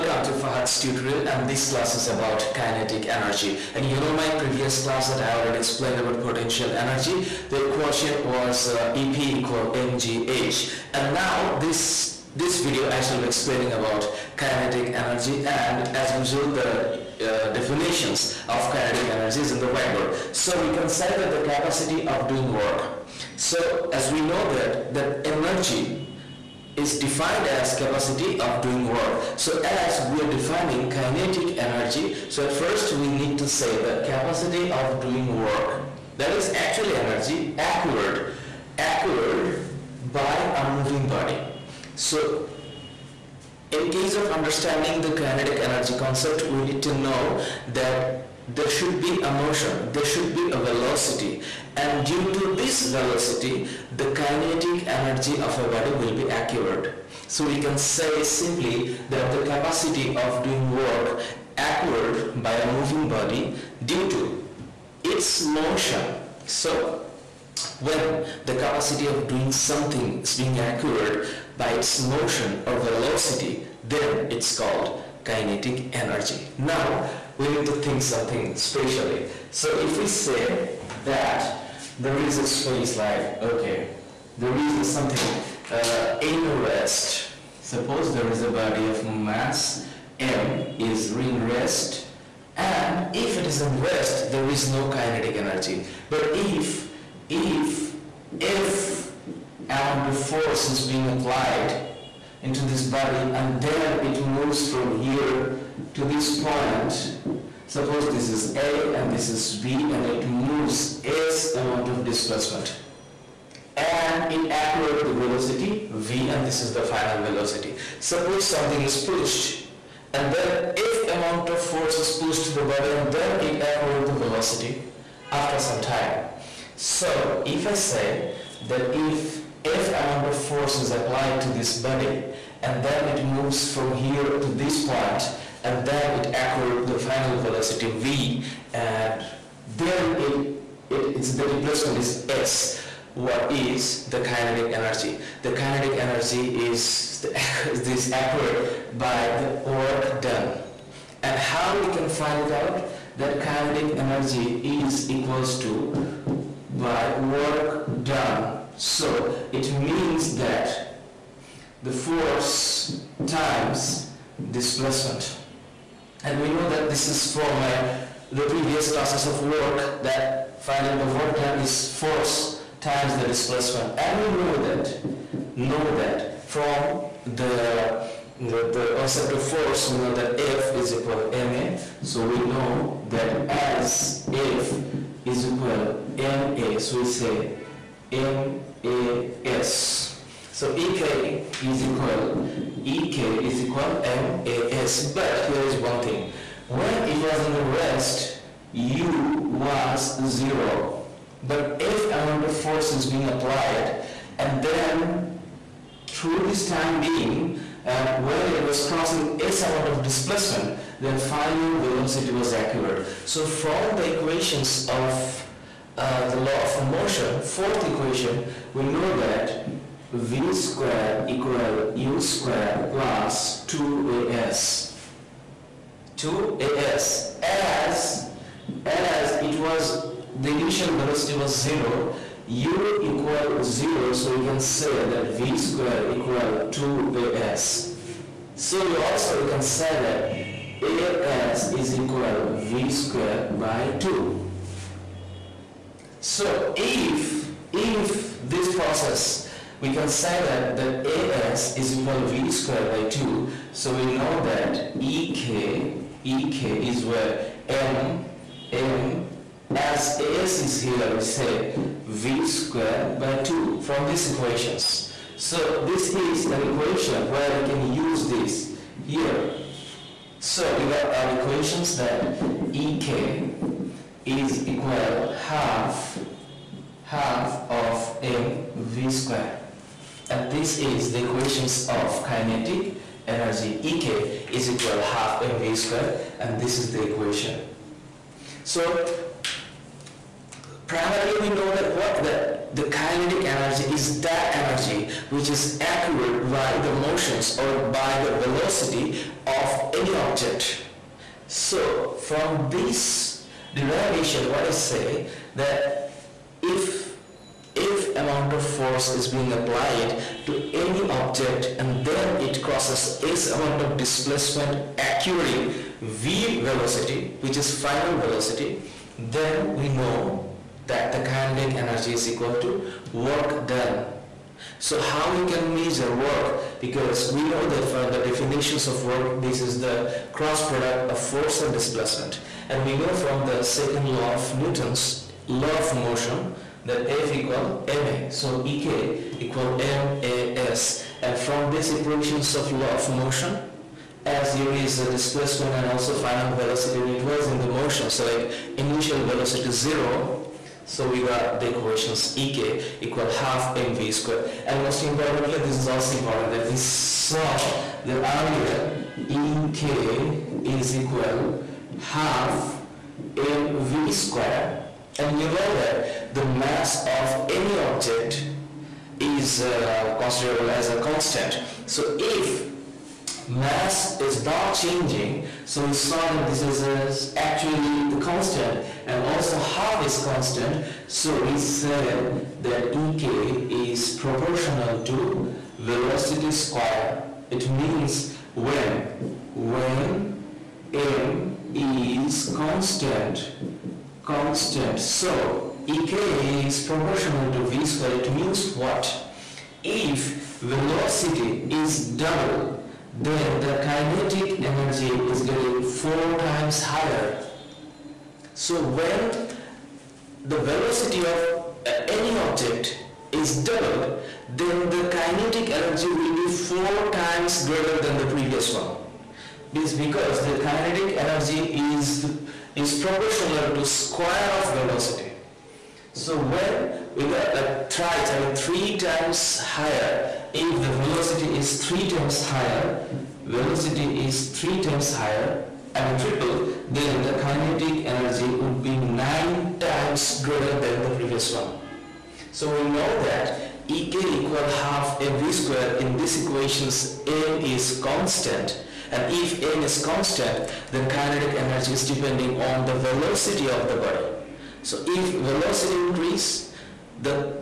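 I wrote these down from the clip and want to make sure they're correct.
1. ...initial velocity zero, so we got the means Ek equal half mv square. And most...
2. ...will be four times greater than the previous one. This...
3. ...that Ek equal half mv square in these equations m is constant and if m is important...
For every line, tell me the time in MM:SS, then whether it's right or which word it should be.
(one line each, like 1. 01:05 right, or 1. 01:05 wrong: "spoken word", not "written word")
1. 05:48 wrong: "equations", not "means"
2. 06:56 right
3. 07:23 wrong: "constant", not "important".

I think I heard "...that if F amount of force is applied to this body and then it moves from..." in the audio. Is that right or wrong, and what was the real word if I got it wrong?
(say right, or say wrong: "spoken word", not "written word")
right.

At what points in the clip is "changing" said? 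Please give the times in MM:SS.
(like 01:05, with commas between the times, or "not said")
06:14.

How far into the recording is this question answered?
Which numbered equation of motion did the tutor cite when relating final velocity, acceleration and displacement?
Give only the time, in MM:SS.
03:37.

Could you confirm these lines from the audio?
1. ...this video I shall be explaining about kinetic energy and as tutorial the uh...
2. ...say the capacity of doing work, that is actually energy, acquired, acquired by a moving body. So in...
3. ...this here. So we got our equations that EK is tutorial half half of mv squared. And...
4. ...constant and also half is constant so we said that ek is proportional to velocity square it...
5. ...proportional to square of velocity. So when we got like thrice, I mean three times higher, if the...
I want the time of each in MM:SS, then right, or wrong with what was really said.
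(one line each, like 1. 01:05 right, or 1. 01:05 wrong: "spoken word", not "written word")
1. 00:12 wrong: "usual", not "tutorial"
2. 00:33 right
3. 04:28 wrong: "equal", not "tutorial"
4. 06:18 right
5. 07:02 right.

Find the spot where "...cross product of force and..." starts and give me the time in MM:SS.
05:30.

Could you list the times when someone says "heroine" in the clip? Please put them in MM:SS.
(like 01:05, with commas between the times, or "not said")
not said.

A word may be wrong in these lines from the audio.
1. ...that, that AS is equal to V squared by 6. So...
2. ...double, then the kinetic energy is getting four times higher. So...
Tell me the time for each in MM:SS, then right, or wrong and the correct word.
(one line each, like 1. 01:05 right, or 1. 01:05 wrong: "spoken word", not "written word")
1. 04:10 wrong: "2", not "6"
2. 06:42 right.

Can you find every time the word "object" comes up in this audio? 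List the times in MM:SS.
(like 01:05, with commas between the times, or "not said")
05:00, 05:11, 06:07, 06:52.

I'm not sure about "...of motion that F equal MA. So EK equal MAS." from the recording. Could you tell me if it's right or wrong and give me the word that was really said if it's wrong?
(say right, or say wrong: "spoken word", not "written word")
right.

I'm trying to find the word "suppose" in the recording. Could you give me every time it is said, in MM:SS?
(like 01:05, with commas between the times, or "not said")
01:27, 01:47, 01:57.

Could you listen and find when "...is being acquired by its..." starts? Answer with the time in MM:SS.
01:10.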